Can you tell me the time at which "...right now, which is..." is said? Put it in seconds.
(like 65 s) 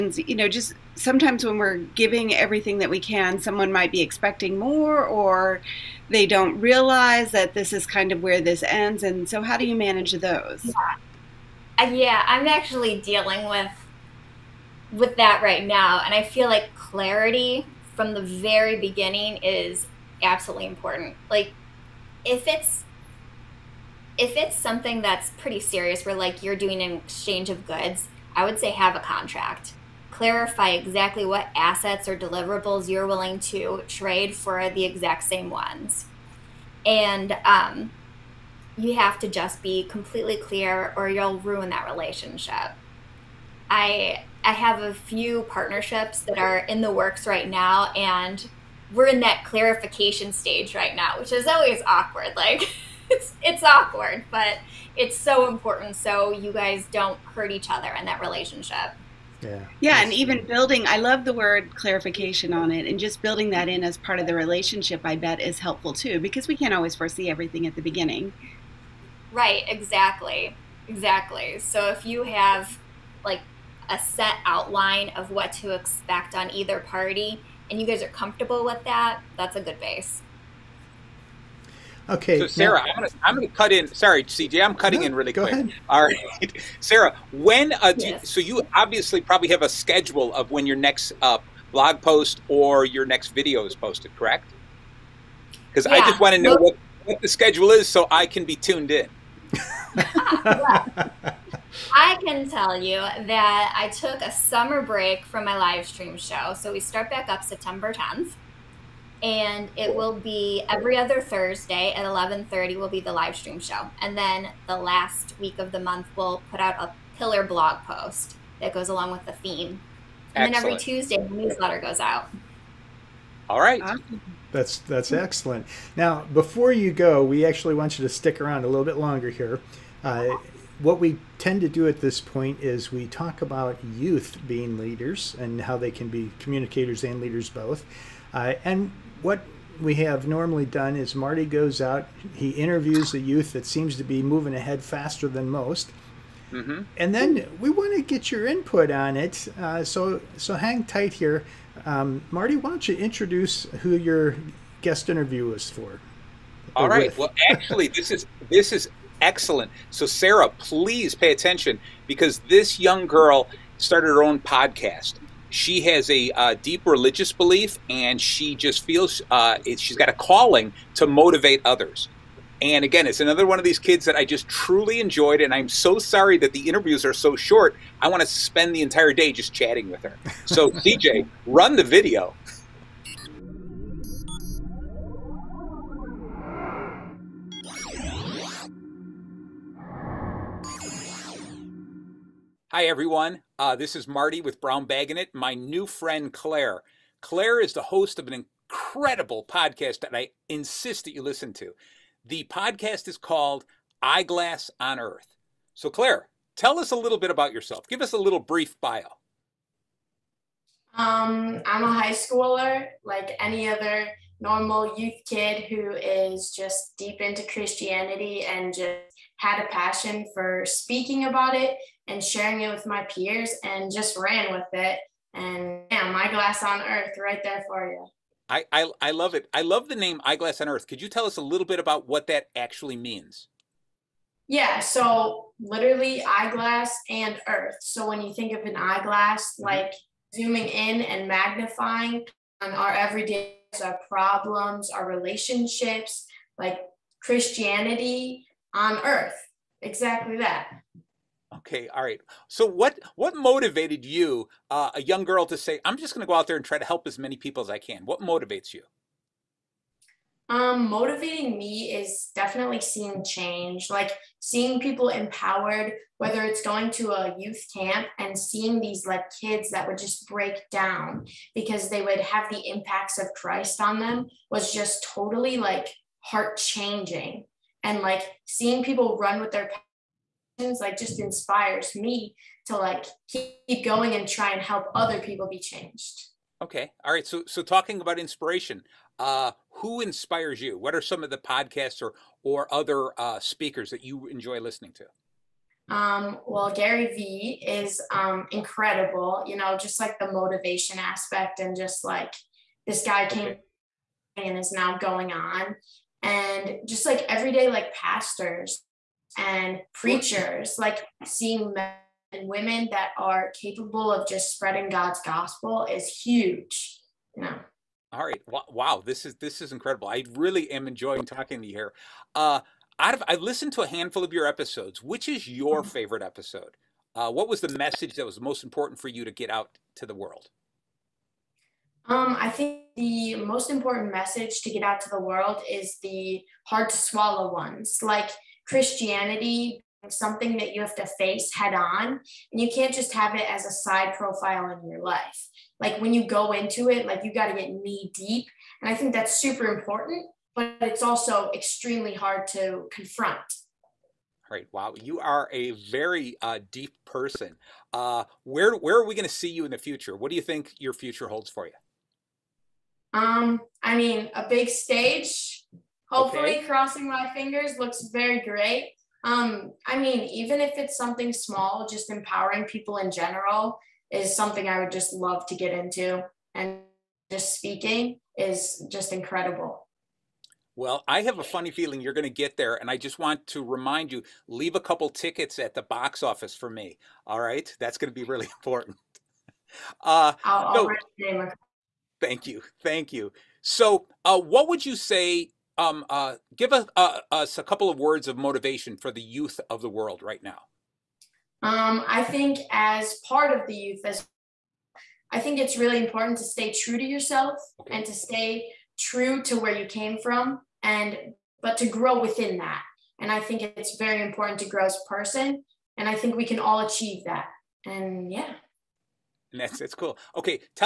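50 s.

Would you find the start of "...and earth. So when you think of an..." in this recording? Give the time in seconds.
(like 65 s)
237 s.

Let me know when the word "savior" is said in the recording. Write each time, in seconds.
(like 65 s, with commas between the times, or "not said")
not said.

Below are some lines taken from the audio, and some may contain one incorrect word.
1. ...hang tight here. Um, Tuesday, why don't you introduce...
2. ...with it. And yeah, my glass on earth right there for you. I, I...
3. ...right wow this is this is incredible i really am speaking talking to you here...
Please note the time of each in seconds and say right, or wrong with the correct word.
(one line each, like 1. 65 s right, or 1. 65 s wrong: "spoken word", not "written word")
1. 150 s wrong: "Marty", not "Tuesday"
2. 224 s right
3. 318 s wrong: "enjoying", not "speaking".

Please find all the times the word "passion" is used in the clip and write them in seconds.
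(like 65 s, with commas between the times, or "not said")
219 s, 280 s.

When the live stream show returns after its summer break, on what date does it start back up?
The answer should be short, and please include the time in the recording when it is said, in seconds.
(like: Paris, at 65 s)
September 10th, at 107 s.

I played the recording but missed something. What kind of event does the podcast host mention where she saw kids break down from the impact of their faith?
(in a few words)
youth camp.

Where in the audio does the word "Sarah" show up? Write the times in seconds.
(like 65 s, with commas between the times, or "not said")
82 s, 86 s, 160 s.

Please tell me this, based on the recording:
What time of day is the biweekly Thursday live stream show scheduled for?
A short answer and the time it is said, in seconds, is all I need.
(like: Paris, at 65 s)
11:30, at 112 s.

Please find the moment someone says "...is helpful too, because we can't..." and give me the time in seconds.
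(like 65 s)
65 s.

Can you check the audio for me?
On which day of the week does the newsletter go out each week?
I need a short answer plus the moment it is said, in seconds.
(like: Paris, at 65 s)
Tuesday, at 120 s.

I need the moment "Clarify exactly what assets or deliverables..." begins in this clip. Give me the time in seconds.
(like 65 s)
30 s.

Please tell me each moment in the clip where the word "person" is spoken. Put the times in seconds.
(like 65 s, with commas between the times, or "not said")
357 s, 415 s.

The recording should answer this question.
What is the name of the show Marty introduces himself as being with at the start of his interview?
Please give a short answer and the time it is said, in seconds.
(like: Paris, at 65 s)
Brown Bag'n It, at 194 s.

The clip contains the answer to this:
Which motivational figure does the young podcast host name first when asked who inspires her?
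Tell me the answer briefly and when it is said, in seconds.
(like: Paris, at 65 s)
Gary Vee, at 296 s.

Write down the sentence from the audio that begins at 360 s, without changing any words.
What do you think your future holds for you?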